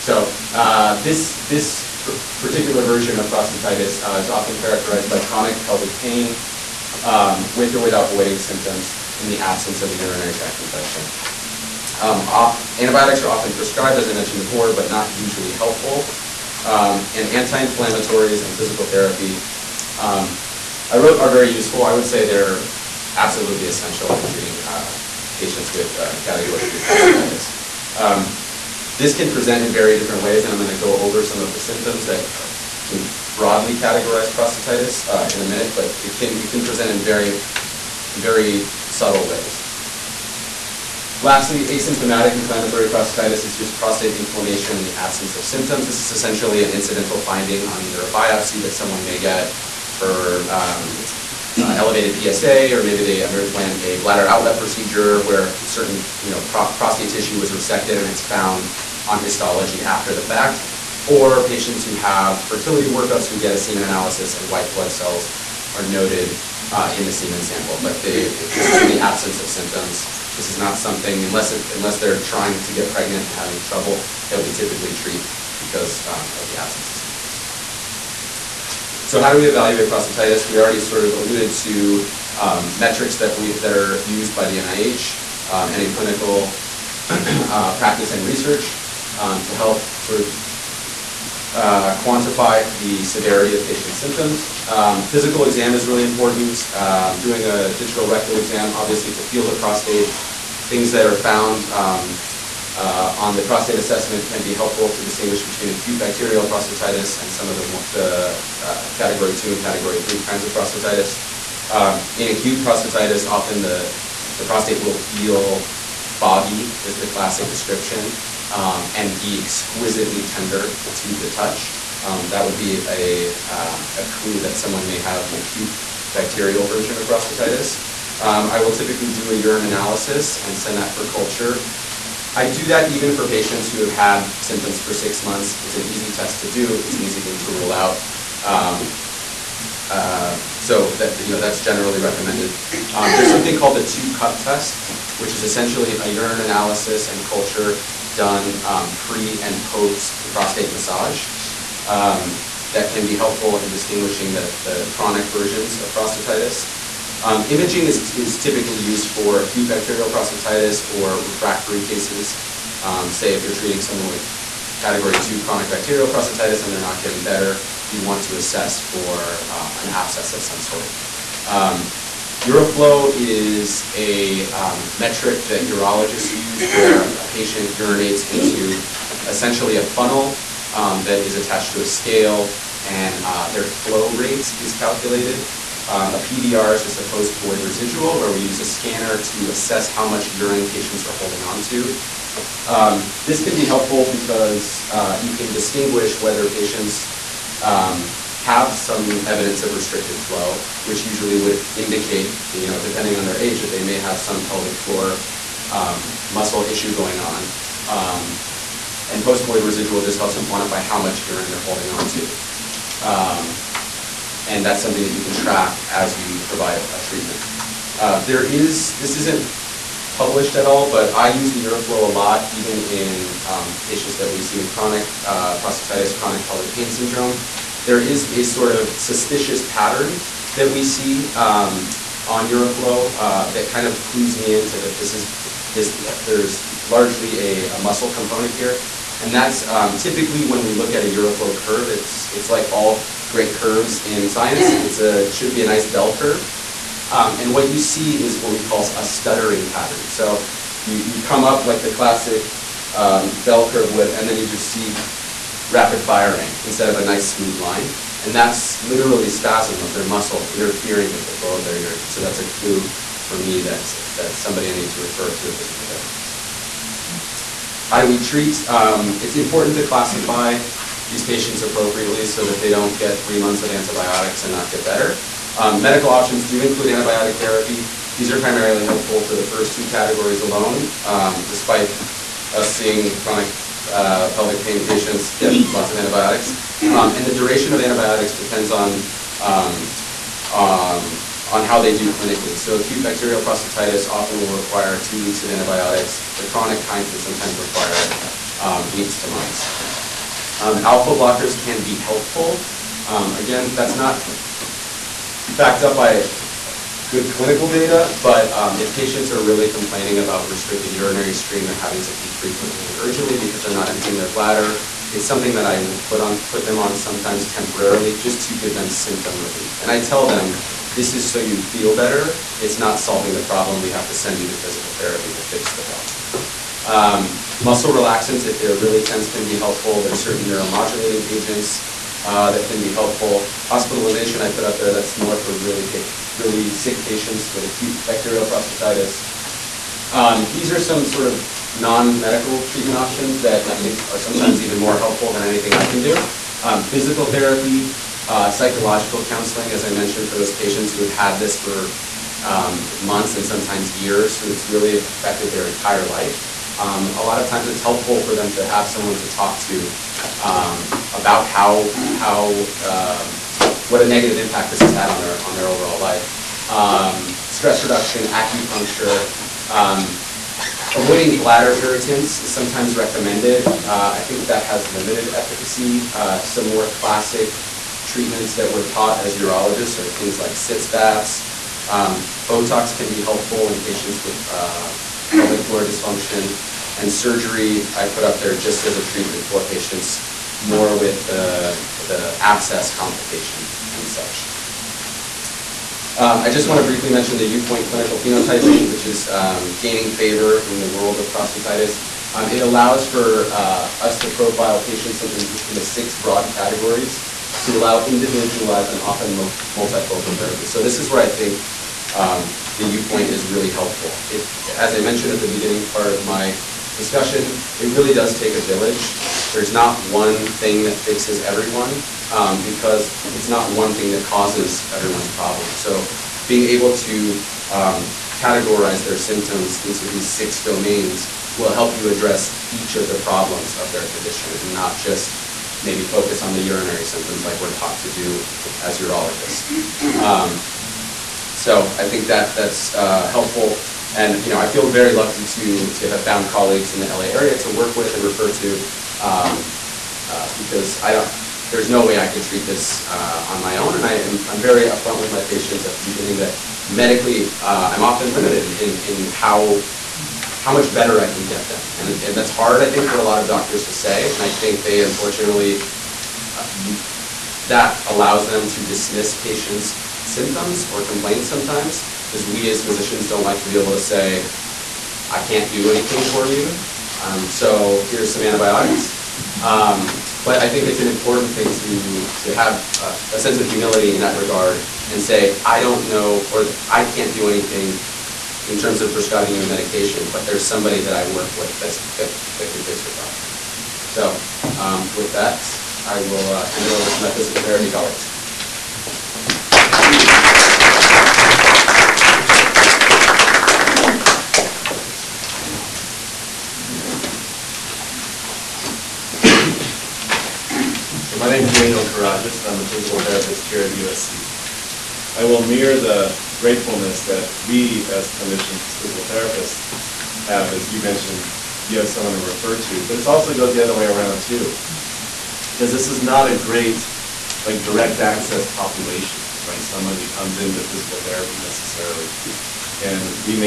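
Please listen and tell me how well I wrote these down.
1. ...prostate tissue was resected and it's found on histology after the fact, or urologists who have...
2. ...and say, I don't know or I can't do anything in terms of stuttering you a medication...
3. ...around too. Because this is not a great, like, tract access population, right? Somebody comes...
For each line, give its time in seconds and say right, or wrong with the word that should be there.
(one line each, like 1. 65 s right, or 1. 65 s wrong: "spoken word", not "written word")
1. 56 s wrong: "patients", not "urologists"
2. 485 s wrong: "prescribing", not "stuttering"
3. 524 s wrong: "direct", not "tract".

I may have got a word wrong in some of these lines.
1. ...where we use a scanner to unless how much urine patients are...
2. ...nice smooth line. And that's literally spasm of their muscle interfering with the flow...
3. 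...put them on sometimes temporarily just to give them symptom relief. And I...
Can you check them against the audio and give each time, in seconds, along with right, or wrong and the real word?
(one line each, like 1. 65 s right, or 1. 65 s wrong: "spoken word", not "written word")
1. 188 s wrong: "assess", not "unless"
2. 257 s right
3. 316 s right.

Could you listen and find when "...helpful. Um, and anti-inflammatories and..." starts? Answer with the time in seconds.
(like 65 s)
15 s.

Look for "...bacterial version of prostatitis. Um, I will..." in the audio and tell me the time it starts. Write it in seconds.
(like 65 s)
126 s.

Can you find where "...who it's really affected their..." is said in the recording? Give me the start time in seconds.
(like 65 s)
354 s.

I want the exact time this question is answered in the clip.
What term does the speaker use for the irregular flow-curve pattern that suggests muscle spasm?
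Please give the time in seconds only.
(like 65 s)
249 s.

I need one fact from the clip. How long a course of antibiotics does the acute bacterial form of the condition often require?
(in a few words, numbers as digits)
two weeks.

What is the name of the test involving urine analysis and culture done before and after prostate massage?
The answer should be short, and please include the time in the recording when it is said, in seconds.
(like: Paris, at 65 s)
two cup test, at 143 s.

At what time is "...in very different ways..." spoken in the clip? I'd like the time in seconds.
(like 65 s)
29 s.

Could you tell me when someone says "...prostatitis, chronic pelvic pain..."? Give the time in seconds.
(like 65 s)
225 s.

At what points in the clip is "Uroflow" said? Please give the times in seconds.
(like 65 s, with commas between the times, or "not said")
172 s, 221 s, 232 s, 241 s.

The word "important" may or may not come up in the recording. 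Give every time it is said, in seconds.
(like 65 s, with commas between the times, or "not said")
96 s, 269 s, 481 s.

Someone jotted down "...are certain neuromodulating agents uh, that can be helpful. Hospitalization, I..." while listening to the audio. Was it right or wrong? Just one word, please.
right.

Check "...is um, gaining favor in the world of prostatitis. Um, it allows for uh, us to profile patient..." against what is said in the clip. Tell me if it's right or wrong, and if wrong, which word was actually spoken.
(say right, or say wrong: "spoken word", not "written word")
right.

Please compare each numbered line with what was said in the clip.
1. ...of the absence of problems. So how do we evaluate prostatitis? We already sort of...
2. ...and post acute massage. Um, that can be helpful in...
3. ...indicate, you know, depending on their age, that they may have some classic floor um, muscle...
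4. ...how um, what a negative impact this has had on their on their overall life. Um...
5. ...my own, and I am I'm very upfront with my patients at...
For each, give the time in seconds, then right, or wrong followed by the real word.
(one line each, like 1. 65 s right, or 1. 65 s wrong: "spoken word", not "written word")
1. 76 s wrong: "symptoms", not "problems"
2. 149 s wrong: "prostate", not "acute"
3. 201 s wrong: "pelvic", not "classic"
4. 362 s right
5. 453 s right.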